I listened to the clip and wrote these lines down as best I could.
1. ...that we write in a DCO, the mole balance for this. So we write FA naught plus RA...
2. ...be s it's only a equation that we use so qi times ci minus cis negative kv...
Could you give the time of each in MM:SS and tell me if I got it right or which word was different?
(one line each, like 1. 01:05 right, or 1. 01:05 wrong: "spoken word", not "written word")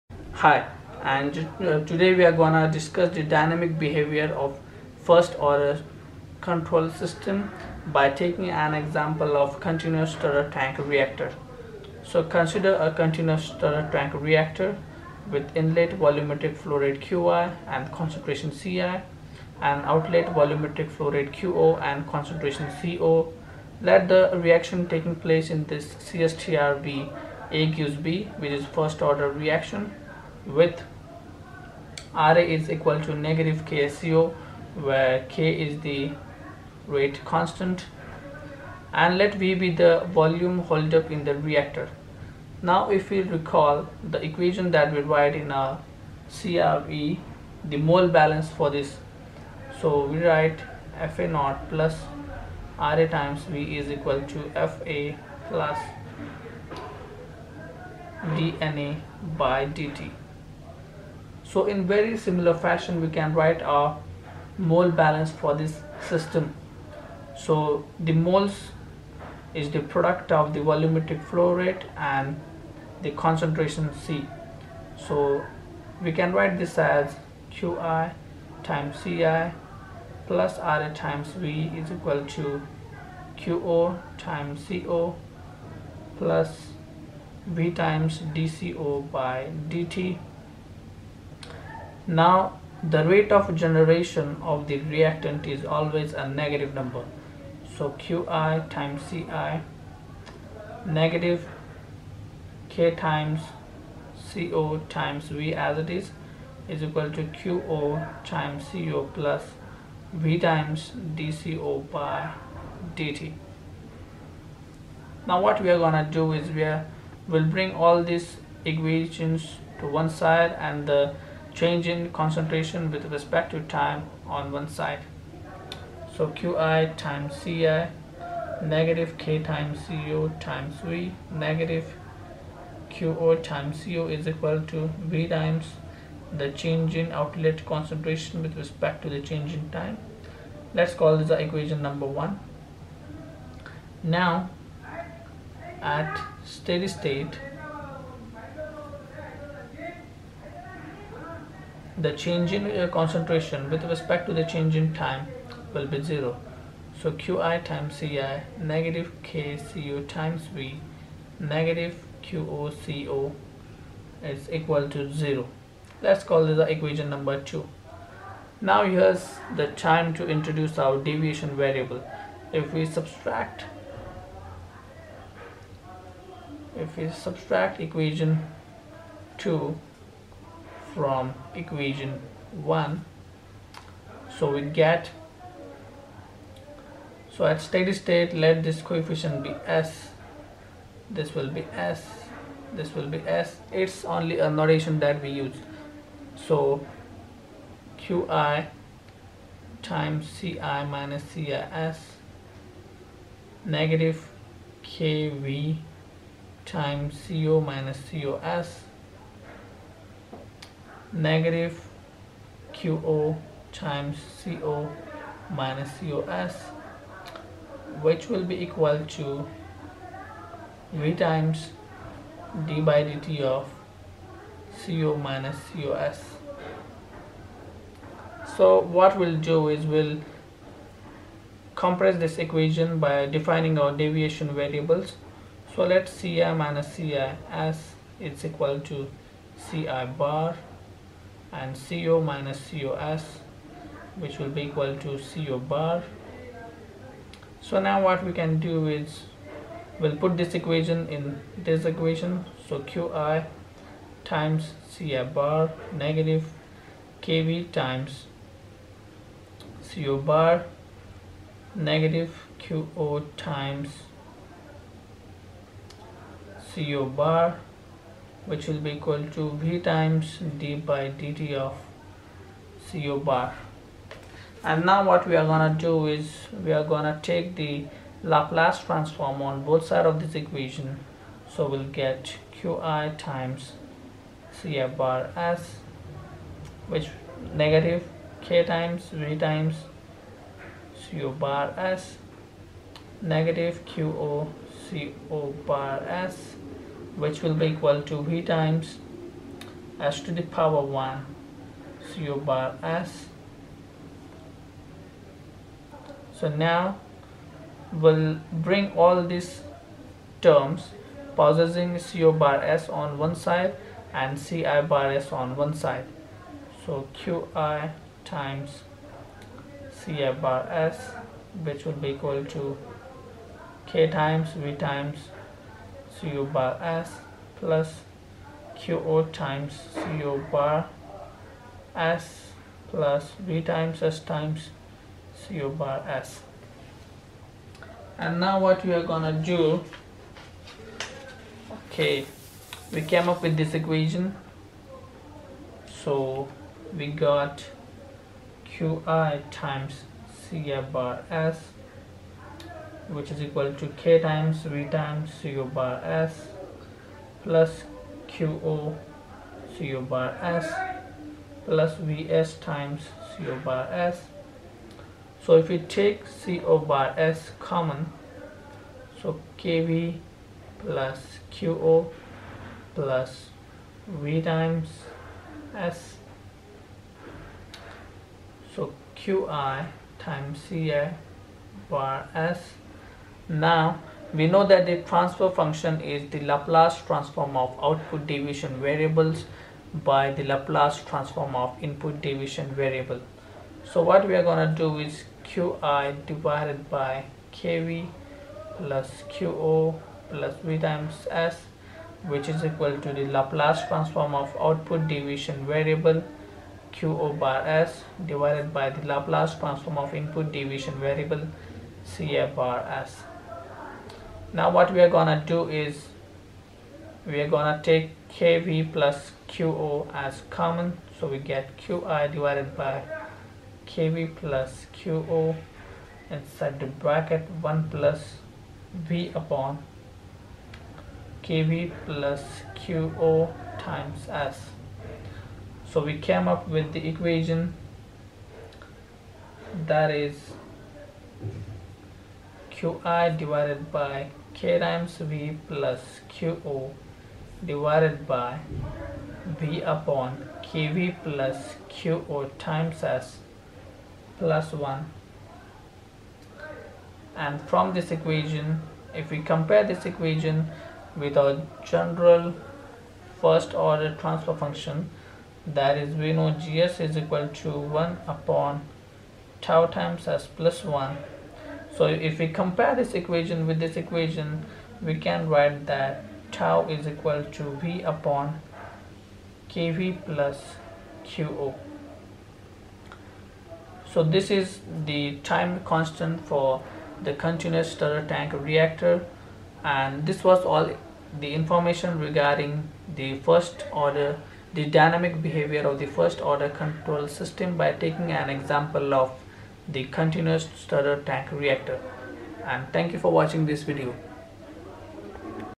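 1. 00:44 wrong: "CRE", not "DCO"
2. 03:13 wrong: "notation", not "equation".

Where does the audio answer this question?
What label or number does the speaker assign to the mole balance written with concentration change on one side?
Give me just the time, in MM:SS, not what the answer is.
02:21.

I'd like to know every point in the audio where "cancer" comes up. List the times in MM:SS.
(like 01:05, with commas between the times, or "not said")
not said.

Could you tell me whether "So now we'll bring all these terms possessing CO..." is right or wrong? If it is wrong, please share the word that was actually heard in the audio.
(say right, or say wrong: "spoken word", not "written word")
right.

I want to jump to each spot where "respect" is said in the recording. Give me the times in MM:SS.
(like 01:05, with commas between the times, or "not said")
02:03, 02:18, 02:33.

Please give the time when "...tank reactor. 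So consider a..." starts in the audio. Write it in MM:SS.
00:10.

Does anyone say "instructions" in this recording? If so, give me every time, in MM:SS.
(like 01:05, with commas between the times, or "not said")
not said.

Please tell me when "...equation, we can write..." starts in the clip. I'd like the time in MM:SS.
07:53.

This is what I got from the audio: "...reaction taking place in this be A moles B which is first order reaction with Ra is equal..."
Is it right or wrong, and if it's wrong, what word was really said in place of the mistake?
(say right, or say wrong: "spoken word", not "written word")
wrong: "gives", not "moles".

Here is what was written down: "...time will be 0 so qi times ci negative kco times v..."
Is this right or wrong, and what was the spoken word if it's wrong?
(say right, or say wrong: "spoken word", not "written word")
right.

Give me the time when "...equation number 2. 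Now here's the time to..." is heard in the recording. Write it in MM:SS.
02:46.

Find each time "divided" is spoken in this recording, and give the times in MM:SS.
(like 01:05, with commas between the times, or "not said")
06:36, 06:48, 07:02, 07:23, 07:27.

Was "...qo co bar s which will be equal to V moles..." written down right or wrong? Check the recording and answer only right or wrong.
wrong.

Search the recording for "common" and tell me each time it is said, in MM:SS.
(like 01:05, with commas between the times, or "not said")
06:07, 07:00.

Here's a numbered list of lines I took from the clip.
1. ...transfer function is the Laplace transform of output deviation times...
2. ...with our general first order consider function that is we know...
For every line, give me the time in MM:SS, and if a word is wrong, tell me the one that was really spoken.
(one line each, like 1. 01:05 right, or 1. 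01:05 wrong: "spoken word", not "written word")
1. 06:25 wrong: "variables", not "times"
2. 07:41 wrong: "transfer", not "consider".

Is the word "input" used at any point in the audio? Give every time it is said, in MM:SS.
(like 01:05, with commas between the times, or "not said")
06:31, 06:50.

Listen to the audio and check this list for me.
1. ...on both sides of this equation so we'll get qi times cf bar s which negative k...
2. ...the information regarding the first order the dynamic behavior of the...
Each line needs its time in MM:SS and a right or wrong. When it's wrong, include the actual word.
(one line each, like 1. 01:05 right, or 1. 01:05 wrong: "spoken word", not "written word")
1. 04:39 right
2. 08:11 right.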